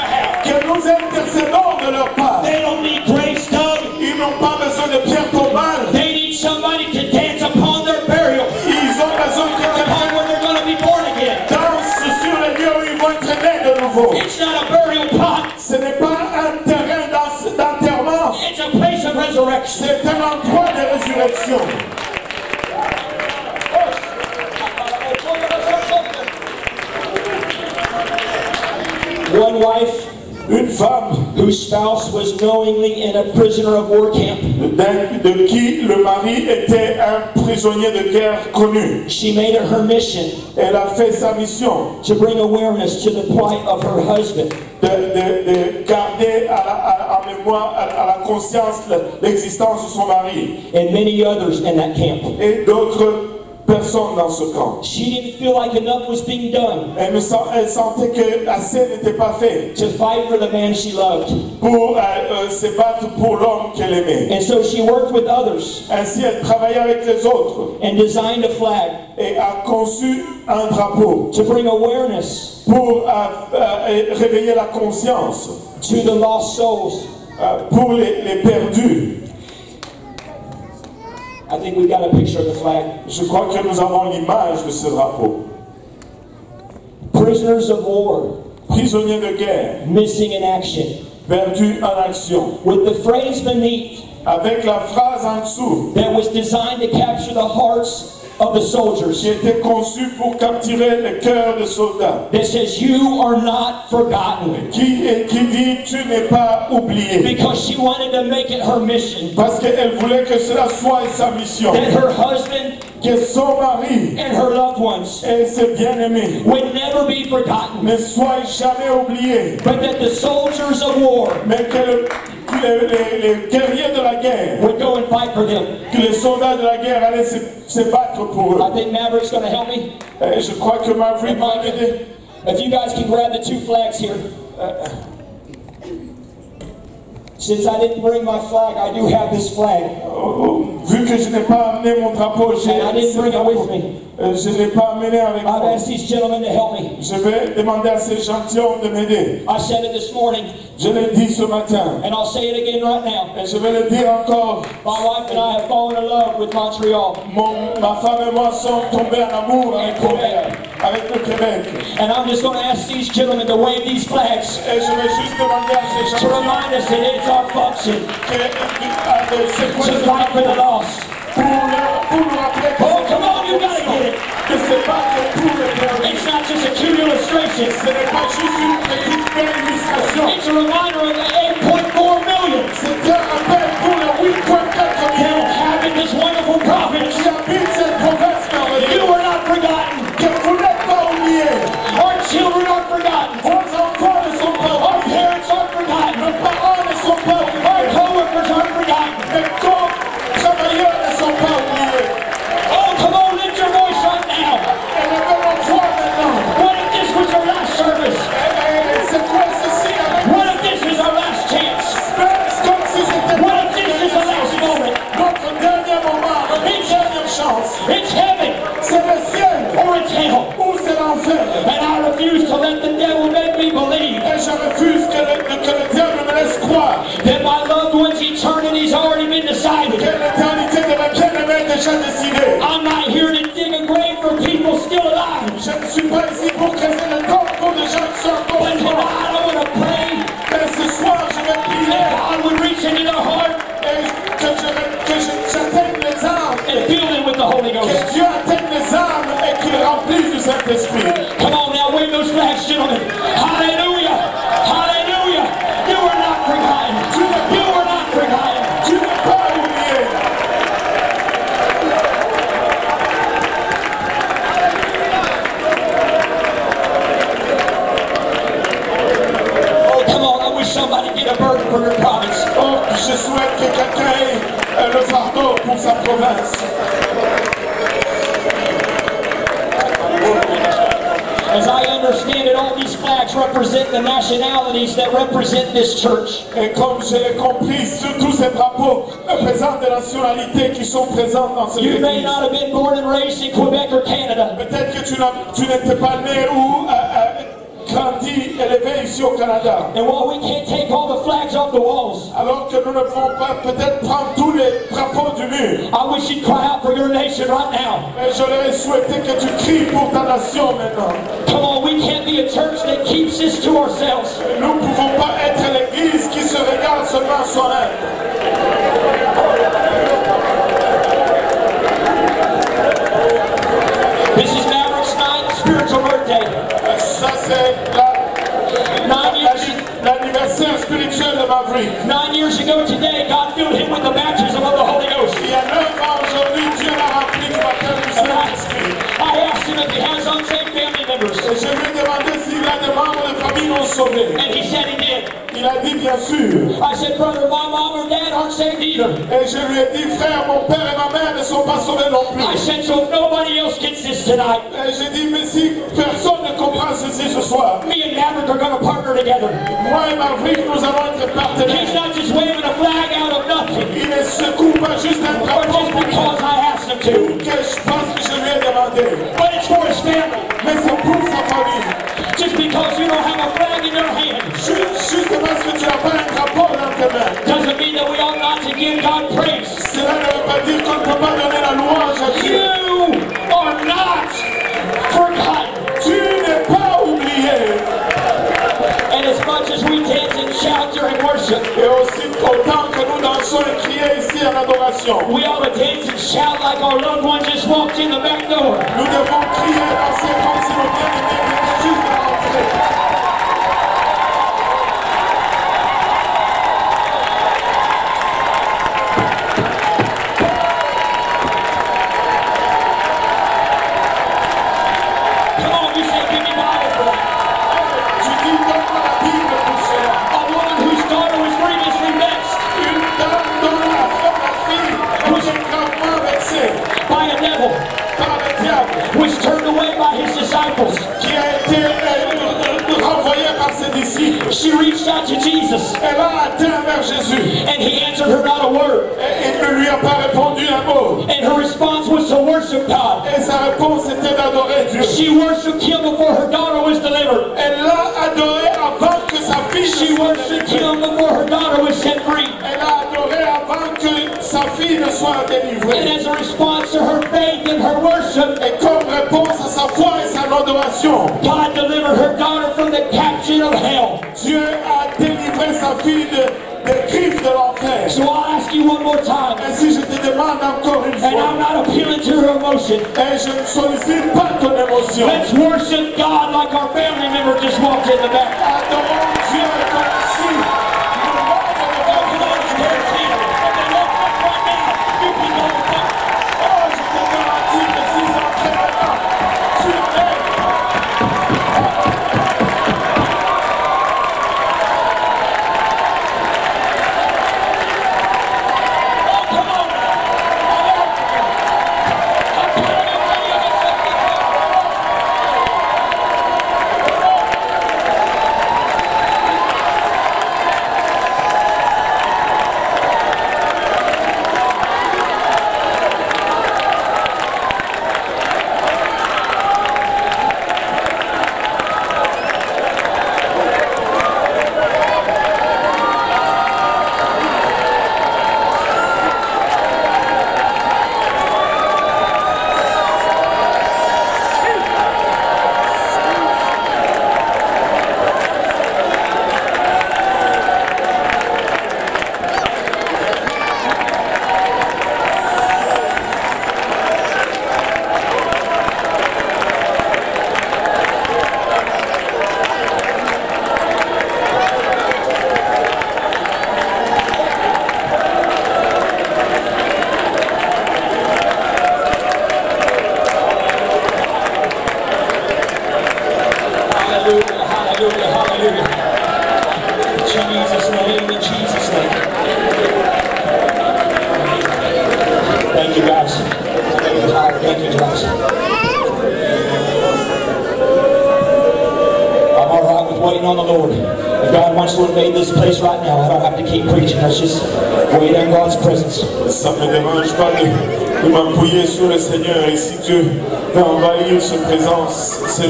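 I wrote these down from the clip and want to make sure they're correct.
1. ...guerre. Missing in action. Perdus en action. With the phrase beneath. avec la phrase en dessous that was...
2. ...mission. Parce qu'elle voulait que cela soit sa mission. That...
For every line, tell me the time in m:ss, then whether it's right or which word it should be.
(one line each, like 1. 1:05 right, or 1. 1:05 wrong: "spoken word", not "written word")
1. 1:29 right
2. 1:48 right.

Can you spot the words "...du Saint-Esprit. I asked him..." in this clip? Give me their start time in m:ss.
5:38.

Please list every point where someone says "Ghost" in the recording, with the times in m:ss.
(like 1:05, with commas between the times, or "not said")
4:07, 5:35.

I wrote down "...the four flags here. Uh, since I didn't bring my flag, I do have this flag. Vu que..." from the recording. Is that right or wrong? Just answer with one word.
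wrong.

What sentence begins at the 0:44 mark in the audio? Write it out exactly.
De, de, de garder à, la, à, à mémoire, à, la conscience l'existence de son mari.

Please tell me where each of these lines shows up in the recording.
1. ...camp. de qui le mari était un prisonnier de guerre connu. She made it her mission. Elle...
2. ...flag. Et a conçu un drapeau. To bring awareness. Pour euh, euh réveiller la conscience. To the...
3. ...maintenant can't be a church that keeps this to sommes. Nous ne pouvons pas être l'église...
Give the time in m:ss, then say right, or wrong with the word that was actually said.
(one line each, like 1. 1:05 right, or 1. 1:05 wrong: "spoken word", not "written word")
1. 0:34 right
2. 1:08 right
3. 5:10 wrong: "ourselves", not "sommes".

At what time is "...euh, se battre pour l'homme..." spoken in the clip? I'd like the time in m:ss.
1:02.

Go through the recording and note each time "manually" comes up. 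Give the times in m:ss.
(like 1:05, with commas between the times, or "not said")
not said.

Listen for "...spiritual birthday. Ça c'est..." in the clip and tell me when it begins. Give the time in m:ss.
5:25.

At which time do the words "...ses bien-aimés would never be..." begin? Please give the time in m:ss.
1:55.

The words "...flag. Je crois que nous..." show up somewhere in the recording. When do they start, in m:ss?
1:22.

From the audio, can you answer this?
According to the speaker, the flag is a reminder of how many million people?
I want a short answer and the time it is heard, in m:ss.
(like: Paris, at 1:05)
8.4 million, at 3:01.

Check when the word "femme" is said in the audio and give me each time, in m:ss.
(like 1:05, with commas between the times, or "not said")
0:30, 2:37.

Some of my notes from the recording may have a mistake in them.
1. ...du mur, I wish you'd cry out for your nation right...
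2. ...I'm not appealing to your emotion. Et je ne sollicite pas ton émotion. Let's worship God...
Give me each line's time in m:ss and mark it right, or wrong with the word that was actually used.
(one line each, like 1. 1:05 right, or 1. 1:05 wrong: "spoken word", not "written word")
1. 5:05 right
2. 7:51 right.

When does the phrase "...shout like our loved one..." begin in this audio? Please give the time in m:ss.
6:36.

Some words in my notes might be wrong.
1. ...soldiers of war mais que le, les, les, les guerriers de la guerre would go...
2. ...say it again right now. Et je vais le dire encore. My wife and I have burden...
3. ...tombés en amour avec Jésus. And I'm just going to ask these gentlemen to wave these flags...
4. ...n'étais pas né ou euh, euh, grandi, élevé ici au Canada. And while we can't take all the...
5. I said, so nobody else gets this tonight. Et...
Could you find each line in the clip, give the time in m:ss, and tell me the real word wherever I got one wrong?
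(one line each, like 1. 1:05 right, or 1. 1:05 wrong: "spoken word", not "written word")
1. 2:00 right
2. 2:32 wrong: "fallen", not "burden"
3. 2:38 wrong: "Robert", not "Jésus"
4. 4:55 right
5. 5:52 right.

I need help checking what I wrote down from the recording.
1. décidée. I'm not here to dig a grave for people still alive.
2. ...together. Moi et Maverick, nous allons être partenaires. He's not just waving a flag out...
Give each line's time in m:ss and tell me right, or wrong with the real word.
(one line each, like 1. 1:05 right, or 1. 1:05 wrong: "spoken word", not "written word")
1. 3:49 right
2. 5:59 right.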